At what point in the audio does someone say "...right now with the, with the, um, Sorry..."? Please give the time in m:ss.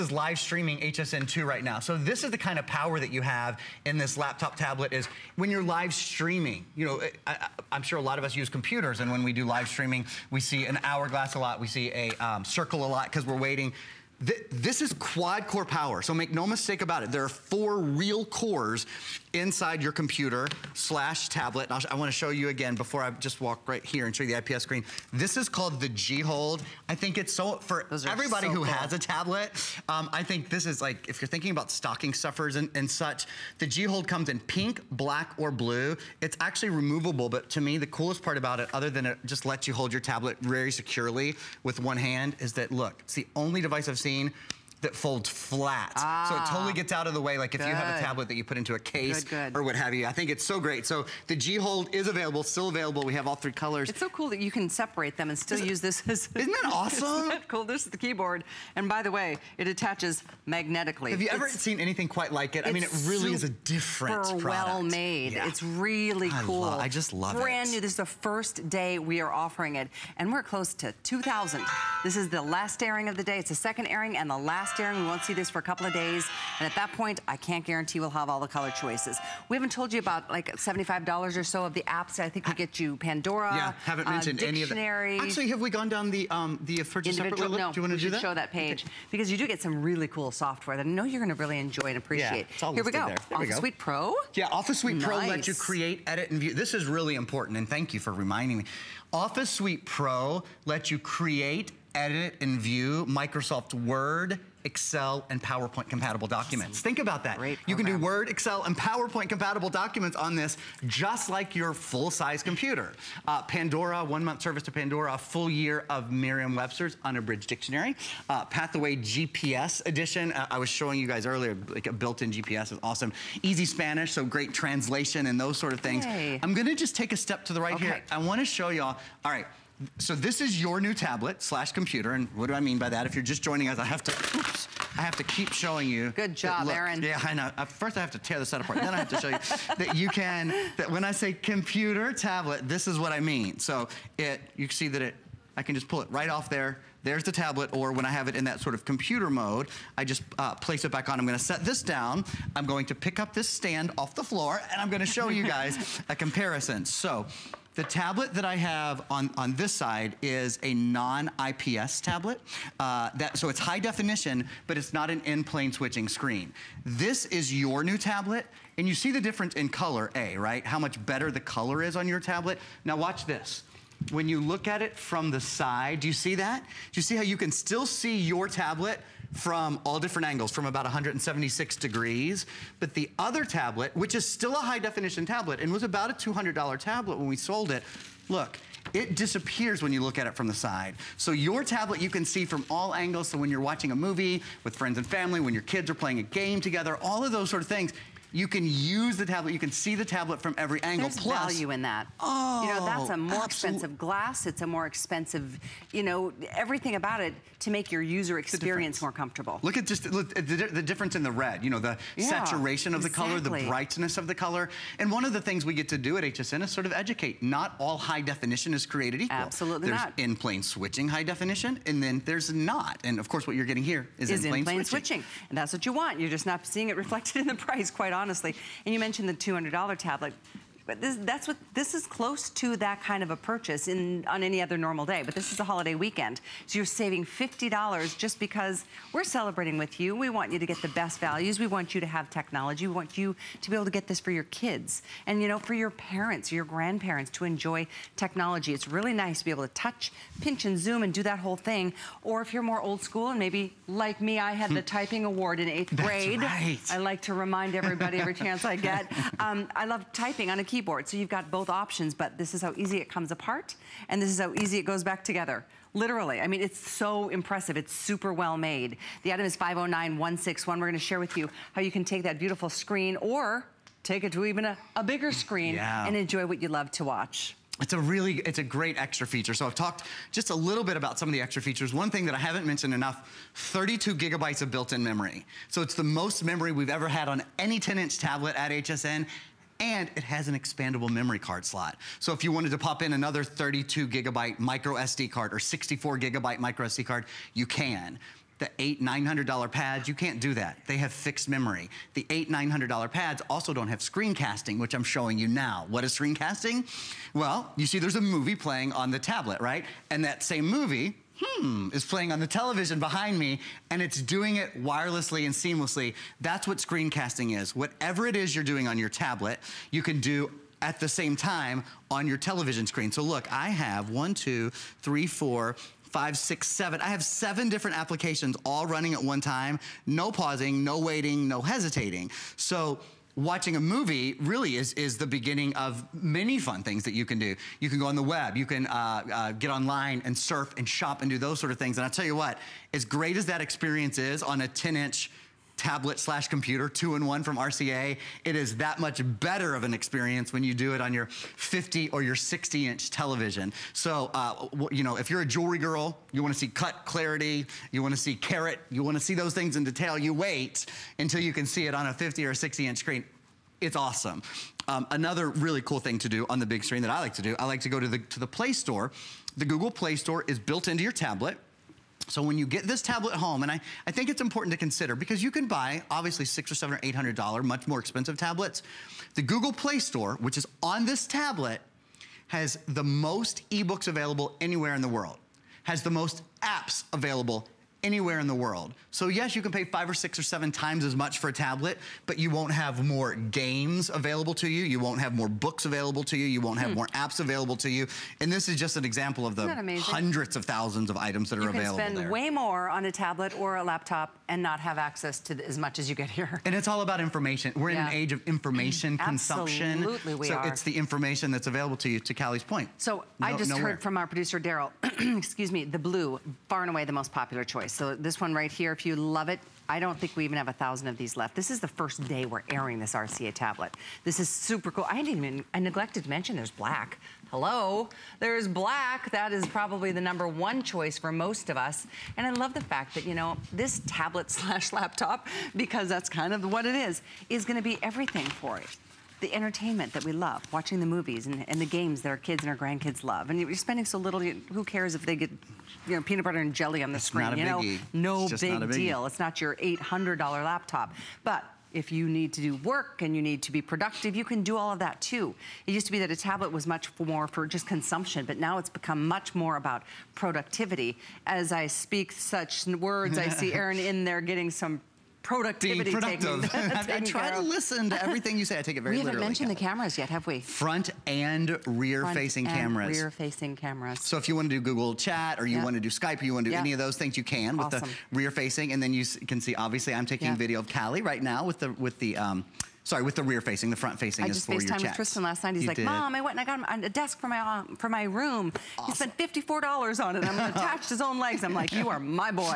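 8:01.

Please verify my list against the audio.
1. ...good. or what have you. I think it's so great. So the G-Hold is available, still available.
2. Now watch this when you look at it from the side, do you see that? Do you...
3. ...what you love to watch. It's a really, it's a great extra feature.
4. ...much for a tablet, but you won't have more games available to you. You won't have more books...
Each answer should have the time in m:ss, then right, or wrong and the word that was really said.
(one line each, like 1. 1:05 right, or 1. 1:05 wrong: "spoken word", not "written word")
1. 0:49 right
2. 2:52 right
3. 4:36 right
4. 6:31 right.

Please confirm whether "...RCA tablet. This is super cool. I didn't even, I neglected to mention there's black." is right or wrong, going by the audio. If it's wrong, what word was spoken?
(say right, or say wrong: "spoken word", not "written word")
right.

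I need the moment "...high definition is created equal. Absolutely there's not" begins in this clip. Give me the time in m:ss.
3:37.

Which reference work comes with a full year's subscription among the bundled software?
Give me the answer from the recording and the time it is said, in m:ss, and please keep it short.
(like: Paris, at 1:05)
Merriam-Webster's Unabridged Dictionary, at 1:56.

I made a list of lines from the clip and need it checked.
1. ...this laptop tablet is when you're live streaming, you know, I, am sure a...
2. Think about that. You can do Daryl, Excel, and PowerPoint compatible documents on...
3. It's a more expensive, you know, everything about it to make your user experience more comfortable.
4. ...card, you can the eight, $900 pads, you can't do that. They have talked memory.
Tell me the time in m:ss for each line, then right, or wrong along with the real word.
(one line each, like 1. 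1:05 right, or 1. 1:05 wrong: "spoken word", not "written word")
1. 0:03 right
2. 1:46 wrong: "Word", not "Daryl"
3. 3:24 right
4. 4:57 wrong: "fixed", not "talked".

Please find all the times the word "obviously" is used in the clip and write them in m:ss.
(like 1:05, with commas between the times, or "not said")
6:16, 7:59.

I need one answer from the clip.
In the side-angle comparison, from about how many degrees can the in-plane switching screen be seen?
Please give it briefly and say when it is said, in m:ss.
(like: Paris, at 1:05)
176 degrees, at 3:00.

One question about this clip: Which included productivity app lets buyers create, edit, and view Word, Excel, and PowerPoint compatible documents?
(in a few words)
Office Suite Pro.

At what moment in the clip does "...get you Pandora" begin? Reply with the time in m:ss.
1:22.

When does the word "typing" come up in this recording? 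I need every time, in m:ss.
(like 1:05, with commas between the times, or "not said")
4:14, 4:20.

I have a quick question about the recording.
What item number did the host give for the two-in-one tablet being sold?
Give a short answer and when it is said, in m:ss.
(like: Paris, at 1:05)
509161, at 4:29.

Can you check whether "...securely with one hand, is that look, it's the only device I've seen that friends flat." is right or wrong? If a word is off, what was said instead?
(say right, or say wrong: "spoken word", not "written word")
wrong: "folds", not "friends".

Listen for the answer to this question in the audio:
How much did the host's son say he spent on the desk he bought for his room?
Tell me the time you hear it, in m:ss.
8:09.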